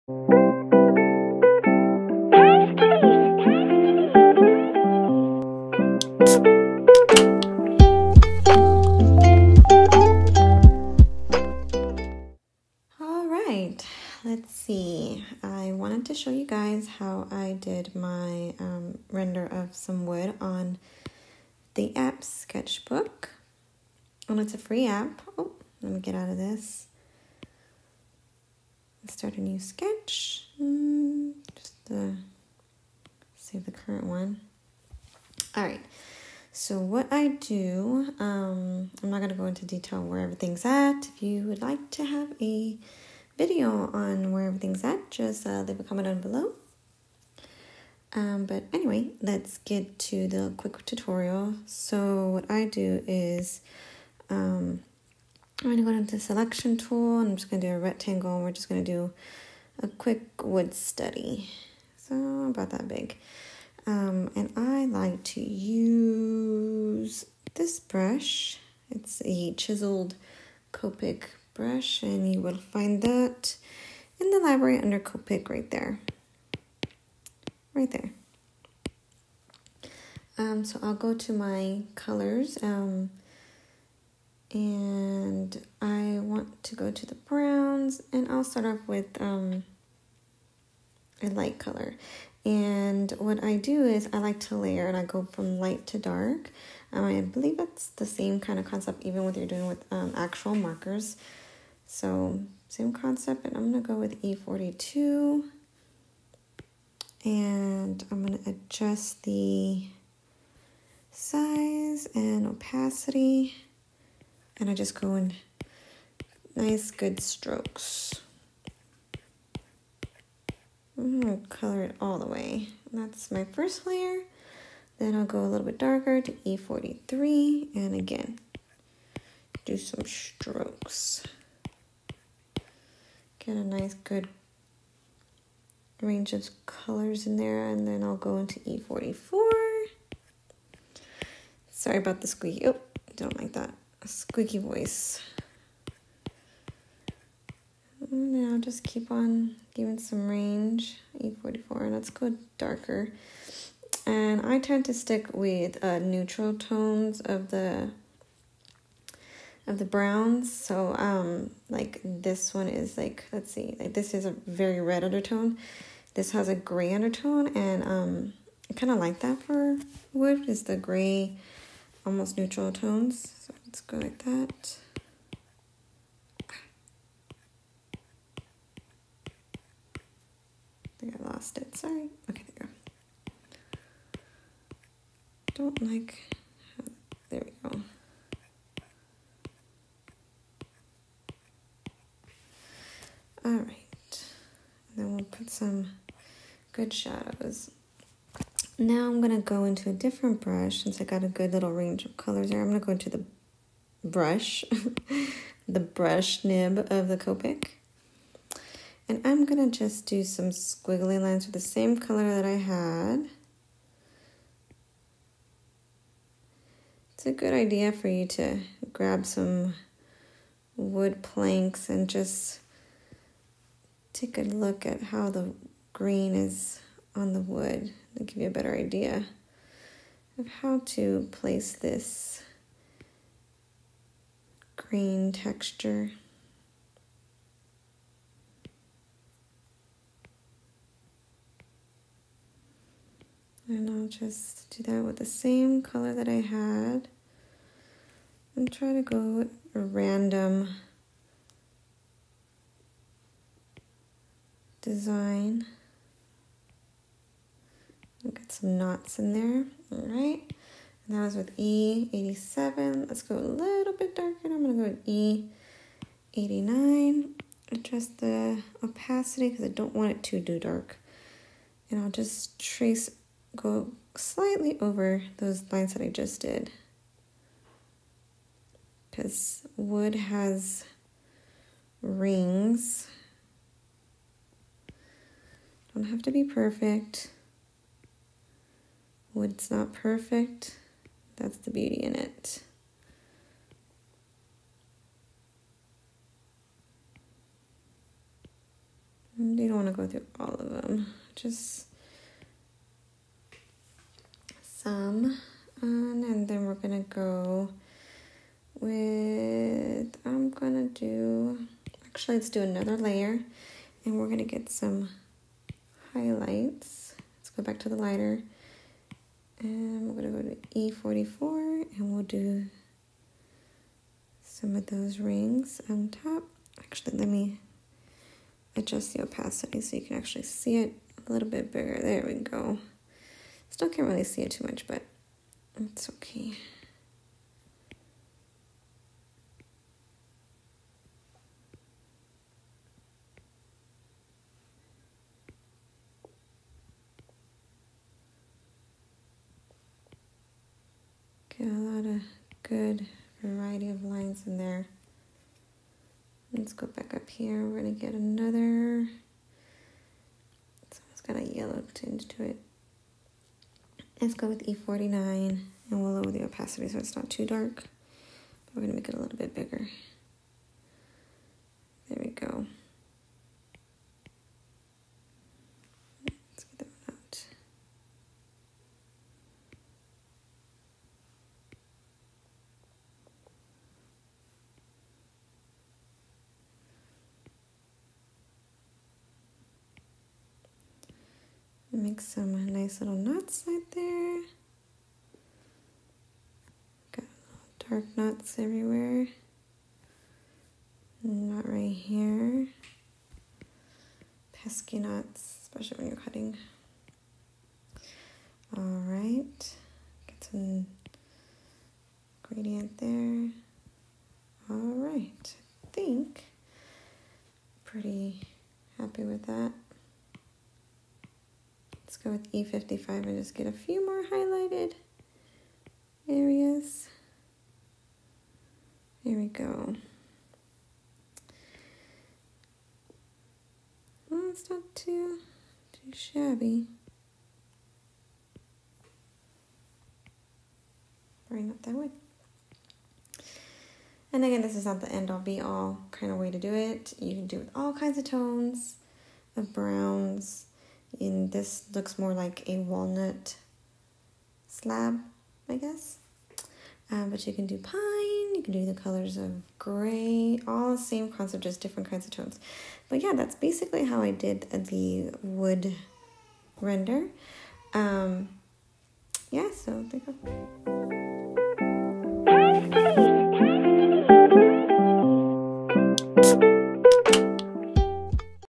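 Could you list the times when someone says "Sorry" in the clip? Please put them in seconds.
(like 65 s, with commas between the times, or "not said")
141 s, 181 s.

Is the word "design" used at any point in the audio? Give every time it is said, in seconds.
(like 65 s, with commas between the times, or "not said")
254 s.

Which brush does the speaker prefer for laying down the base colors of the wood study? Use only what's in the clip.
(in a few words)
chiseled Copic brush.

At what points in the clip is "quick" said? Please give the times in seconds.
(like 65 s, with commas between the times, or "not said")
50 s, 59 s.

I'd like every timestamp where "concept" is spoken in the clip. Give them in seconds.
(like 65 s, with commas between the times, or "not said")
98 s, 102 s, 461 s.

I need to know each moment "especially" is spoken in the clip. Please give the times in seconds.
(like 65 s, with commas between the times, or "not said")
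405 s.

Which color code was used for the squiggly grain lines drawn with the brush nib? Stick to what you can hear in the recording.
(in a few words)
E87.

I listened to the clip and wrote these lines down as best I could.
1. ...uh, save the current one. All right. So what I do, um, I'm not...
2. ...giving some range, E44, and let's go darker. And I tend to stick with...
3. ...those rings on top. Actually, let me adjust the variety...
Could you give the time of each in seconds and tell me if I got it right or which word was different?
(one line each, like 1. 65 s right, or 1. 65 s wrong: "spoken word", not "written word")
1. 32 s right
2. 149 s right
3. 324 s wrong: "opacity", not "variety".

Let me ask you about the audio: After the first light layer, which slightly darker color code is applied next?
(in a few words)
E43.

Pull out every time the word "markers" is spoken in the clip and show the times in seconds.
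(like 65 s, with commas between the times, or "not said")
100 s.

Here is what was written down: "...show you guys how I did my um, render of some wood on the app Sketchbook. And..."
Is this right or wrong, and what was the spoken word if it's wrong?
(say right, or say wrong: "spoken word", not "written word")
right.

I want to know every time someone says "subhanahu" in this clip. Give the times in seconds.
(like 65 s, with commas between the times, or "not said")
not said.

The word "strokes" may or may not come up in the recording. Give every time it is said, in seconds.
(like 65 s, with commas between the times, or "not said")
117 s, 130 s.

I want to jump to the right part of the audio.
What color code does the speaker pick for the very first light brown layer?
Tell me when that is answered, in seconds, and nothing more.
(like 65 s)
104 s.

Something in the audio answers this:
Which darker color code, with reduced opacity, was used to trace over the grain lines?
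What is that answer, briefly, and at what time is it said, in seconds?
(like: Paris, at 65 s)
E89, at 266 s.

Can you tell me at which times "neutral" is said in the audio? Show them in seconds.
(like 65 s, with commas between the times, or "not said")
155 s, 172 s.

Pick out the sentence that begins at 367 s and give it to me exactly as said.
But we're gonna make it a little bit bigger.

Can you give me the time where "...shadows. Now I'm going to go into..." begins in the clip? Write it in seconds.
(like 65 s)
196 s.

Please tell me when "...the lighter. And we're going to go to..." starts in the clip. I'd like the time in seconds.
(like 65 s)
317 s.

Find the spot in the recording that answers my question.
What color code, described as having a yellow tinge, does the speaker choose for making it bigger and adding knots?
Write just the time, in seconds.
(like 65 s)
364 s.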